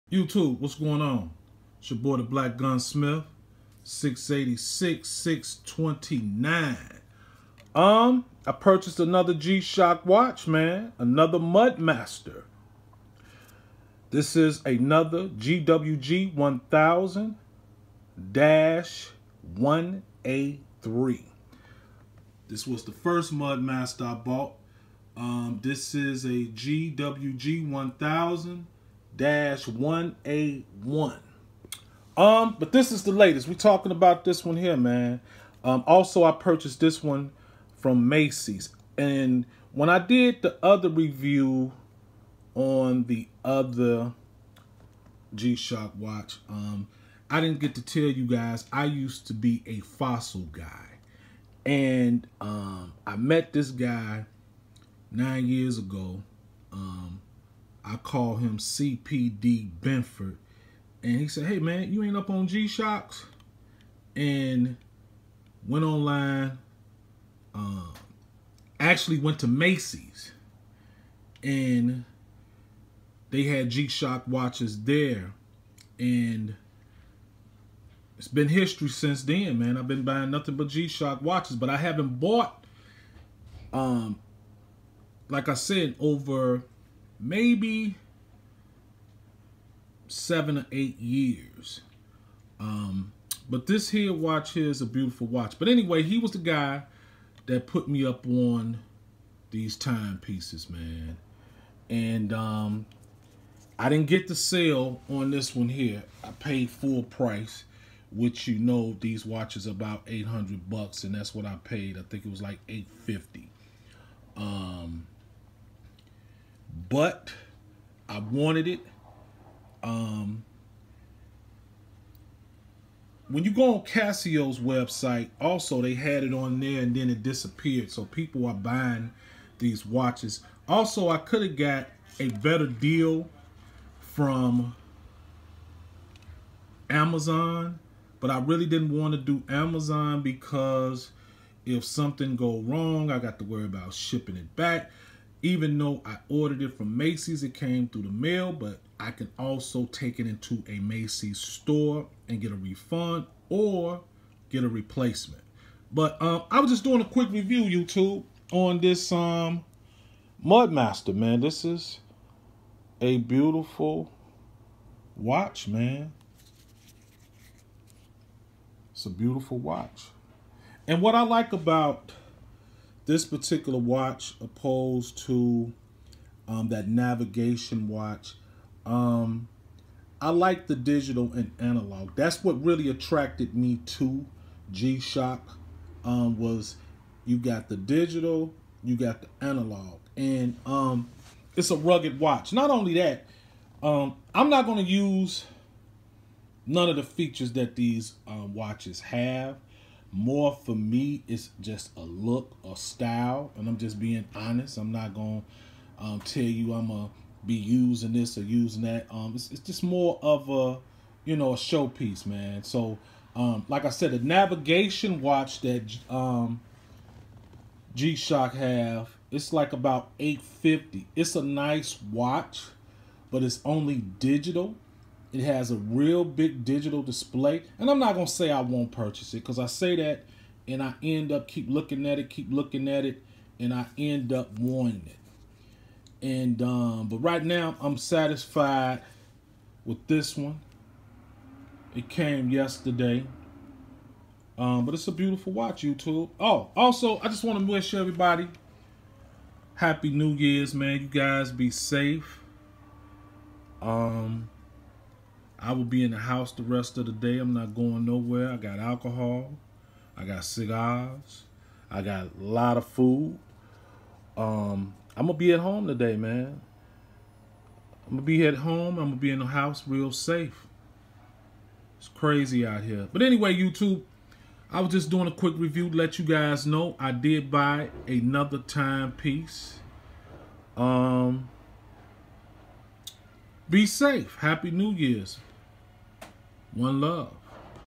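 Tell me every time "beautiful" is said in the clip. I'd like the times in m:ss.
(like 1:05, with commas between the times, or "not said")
1:34, 2:43, 2:49, 4:05.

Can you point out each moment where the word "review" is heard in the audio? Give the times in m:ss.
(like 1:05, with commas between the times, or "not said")
0:40, 2:37, 4:35.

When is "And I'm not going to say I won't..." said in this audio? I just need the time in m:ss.
3:47.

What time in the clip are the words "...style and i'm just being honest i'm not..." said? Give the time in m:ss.
3:22.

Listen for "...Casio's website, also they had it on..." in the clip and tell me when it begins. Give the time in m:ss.
2:03.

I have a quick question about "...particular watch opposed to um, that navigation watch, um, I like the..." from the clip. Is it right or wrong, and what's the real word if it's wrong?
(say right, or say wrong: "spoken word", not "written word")
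right.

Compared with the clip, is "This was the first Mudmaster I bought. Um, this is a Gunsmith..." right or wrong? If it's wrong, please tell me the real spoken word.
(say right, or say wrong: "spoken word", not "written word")
wrong: "GWG", not "Gunsmith".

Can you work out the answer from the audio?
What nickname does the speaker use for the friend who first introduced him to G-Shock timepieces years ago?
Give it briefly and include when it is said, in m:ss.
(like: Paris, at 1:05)
CPD Benford, at 0:58.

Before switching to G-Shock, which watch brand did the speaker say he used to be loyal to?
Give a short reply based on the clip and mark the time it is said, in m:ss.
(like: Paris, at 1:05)
Fossil, at 0:49.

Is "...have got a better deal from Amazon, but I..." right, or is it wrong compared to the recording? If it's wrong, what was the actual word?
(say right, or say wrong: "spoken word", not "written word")
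right.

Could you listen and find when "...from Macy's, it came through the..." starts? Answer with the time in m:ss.
2:26.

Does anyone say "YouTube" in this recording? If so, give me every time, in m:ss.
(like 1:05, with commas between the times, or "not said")
0:00, 2:37, 4:05, 4:33.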